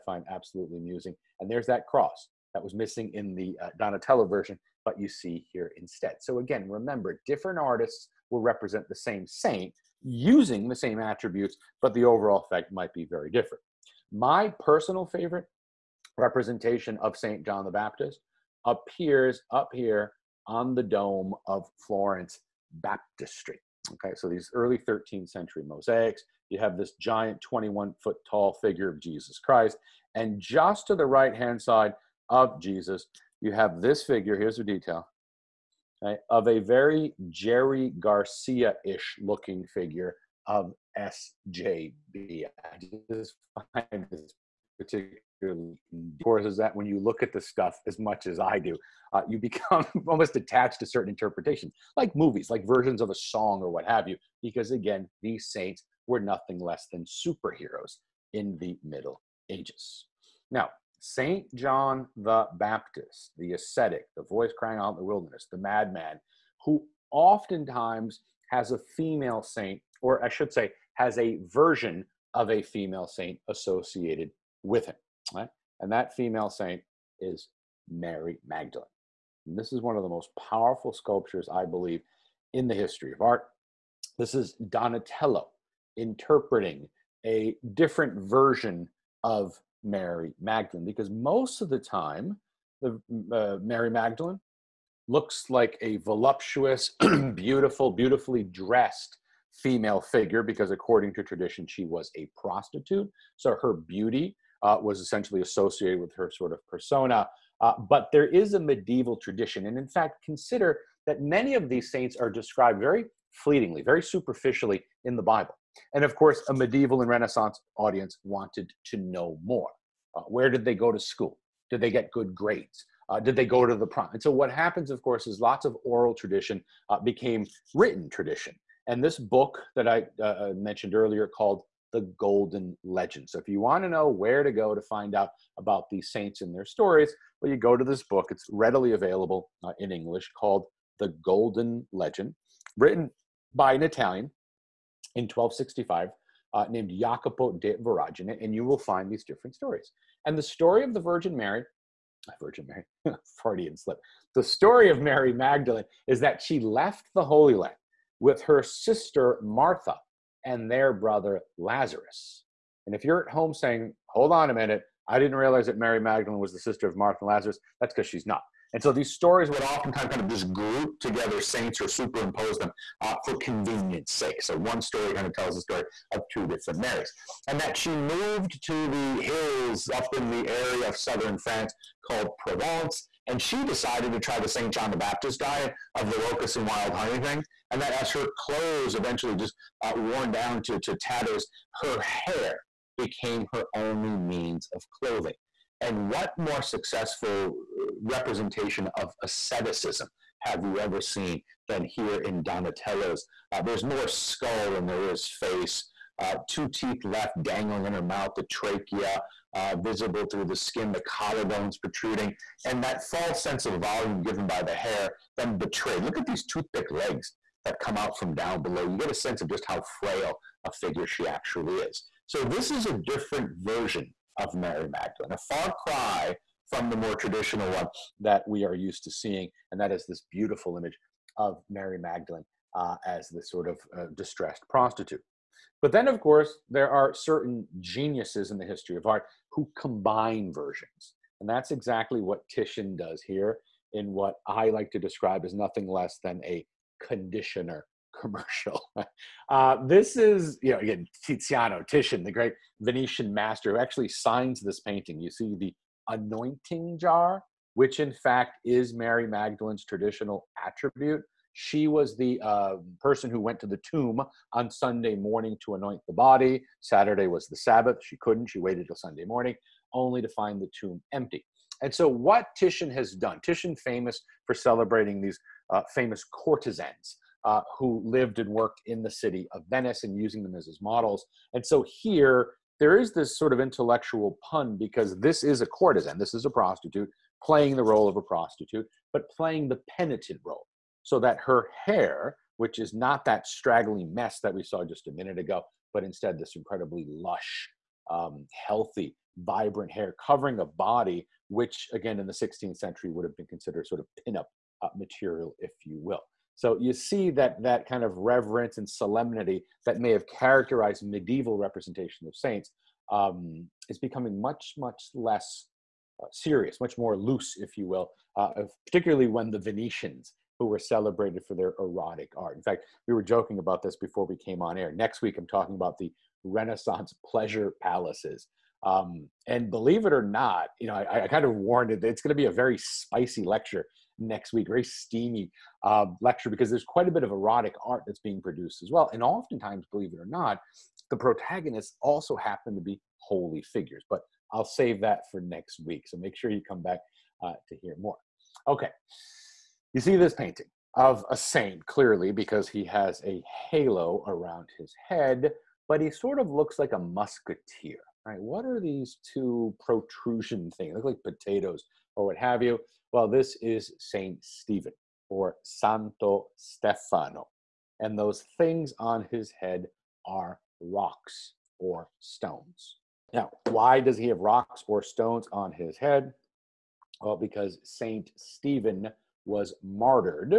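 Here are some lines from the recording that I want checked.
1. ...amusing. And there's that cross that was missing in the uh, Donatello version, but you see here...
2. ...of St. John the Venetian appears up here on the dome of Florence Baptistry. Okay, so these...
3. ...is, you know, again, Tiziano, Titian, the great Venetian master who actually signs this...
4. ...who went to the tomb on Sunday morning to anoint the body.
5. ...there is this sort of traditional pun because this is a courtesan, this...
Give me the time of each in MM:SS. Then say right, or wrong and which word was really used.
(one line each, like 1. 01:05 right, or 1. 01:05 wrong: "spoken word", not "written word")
1. 00:00 right
2. 00:17 wrong: "Baptist", not "Venetian"
3. 04:10 right
4. 04:23 right
5. 04:42 wrong: "intellectual", not "traditional".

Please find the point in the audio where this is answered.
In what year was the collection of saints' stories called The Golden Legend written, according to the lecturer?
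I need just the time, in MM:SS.
02:25.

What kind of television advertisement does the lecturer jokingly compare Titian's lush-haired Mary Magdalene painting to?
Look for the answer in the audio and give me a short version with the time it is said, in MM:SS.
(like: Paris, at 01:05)
a conditioner commercial, at 04:07.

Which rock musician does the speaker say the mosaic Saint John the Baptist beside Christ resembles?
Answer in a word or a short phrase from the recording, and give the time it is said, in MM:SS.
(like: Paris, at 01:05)
Jerry Garcia, at 00:37.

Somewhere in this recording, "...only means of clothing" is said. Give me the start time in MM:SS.
03:13.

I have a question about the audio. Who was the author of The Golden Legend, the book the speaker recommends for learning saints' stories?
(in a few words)
Jacopo de Voragine.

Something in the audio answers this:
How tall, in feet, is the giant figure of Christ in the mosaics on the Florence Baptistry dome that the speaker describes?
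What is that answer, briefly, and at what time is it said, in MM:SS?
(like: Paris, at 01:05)
21 feet, at 00:27.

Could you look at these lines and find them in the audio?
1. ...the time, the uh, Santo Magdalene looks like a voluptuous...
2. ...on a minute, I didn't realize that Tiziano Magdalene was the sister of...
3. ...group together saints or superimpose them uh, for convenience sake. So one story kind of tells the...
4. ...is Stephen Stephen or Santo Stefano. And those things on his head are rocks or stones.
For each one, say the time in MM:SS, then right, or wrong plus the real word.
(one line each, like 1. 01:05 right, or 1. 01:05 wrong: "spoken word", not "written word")
1. 01:31 wrong: "Mary", not "Santo"
2. 02:44 wrong: "Mary", not "Tiziano"
3. 02:50 right
4. 06:03 wrong: "Saint", not "Stephen".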